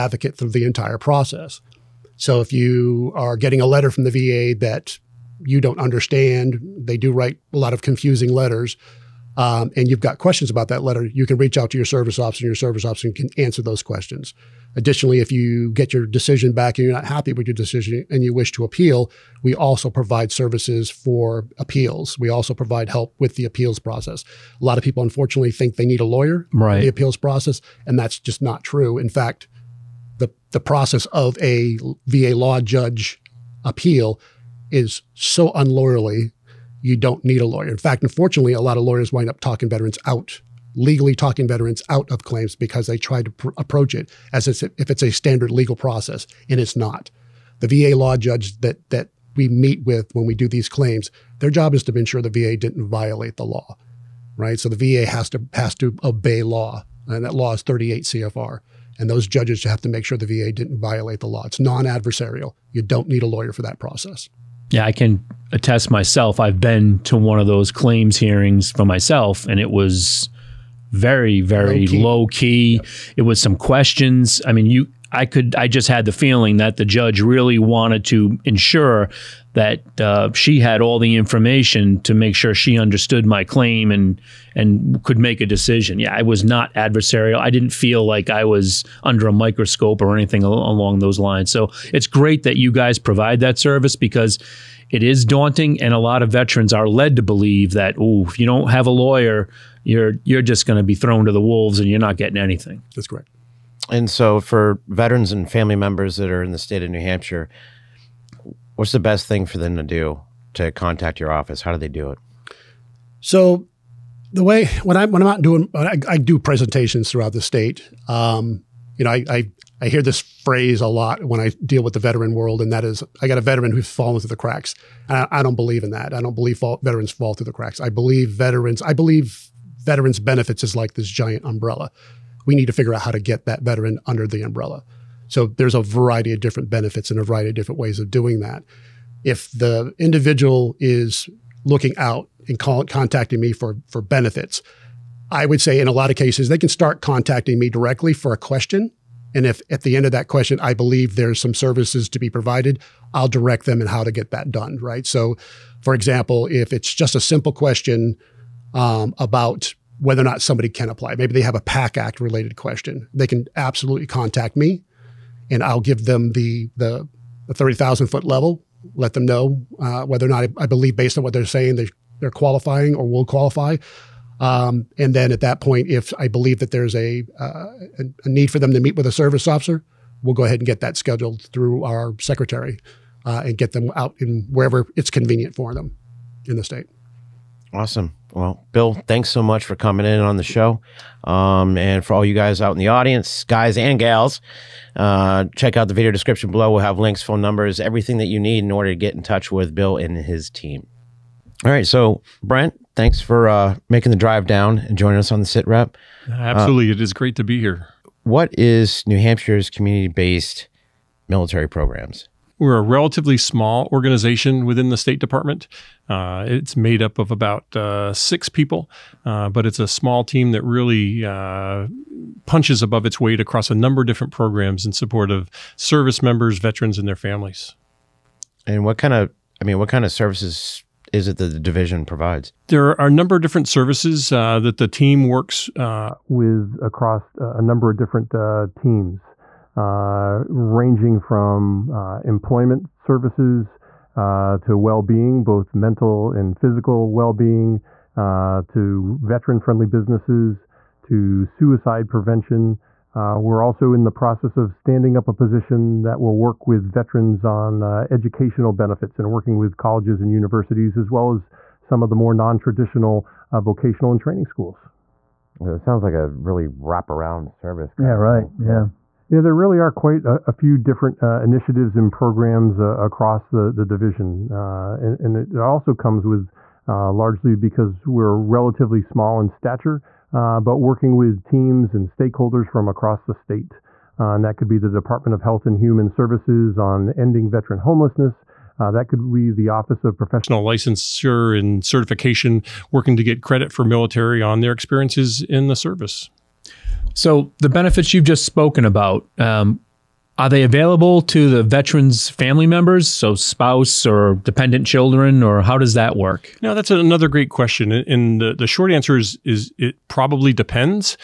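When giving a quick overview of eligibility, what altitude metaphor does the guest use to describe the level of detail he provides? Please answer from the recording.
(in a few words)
30,000 foot level.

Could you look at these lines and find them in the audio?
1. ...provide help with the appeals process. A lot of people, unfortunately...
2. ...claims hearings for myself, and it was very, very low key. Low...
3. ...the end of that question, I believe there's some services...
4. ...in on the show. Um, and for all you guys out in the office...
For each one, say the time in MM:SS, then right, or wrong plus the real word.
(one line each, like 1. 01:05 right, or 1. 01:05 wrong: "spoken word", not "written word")
1. 00:22 right
2. 01:07 right
3. 02:29 right
4. 03:10 wrong: "audience", not "office".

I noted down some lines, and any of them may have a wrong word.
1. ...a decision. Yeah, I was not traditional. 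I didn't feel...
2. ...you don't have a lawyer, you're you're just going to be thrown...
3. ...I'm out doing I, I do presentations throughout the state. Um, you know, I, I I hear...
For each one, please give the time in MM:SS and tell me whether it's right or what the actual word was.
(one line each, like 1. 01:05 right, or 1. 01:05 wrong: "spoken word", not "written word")
1. 01:25 wrong: "adversarial", not "traditional"
2. 01:38 right
3. 01:55 right.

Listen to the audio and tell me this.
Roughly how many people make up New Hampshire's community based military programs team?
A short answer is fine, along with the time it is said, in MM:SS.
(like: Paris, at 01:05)
6, at 03:38.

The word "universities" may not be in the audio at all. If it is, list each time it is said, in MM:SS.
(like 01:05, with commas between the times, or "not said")
04:20.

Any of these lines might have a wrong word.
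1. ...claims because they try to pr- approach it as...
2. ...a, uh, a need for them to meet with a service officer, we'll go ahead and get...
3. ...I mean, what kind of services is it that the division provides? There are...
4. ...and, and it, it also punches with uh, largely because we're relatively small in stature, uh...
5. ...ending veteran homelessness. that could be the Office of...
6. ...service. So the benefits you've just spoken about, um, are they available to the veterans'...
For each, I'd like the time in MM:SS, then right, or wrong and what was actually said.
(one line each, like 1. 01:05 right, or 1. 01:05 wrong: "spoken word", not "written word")
1. 00:42 right
2. 02:56 right
3. 03:49 right
4. 04:34 wrong: "comes", not "punches"
5. 04:47 right
6. 04:55 right.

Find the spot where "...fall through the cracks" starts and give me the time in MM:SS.
02:07.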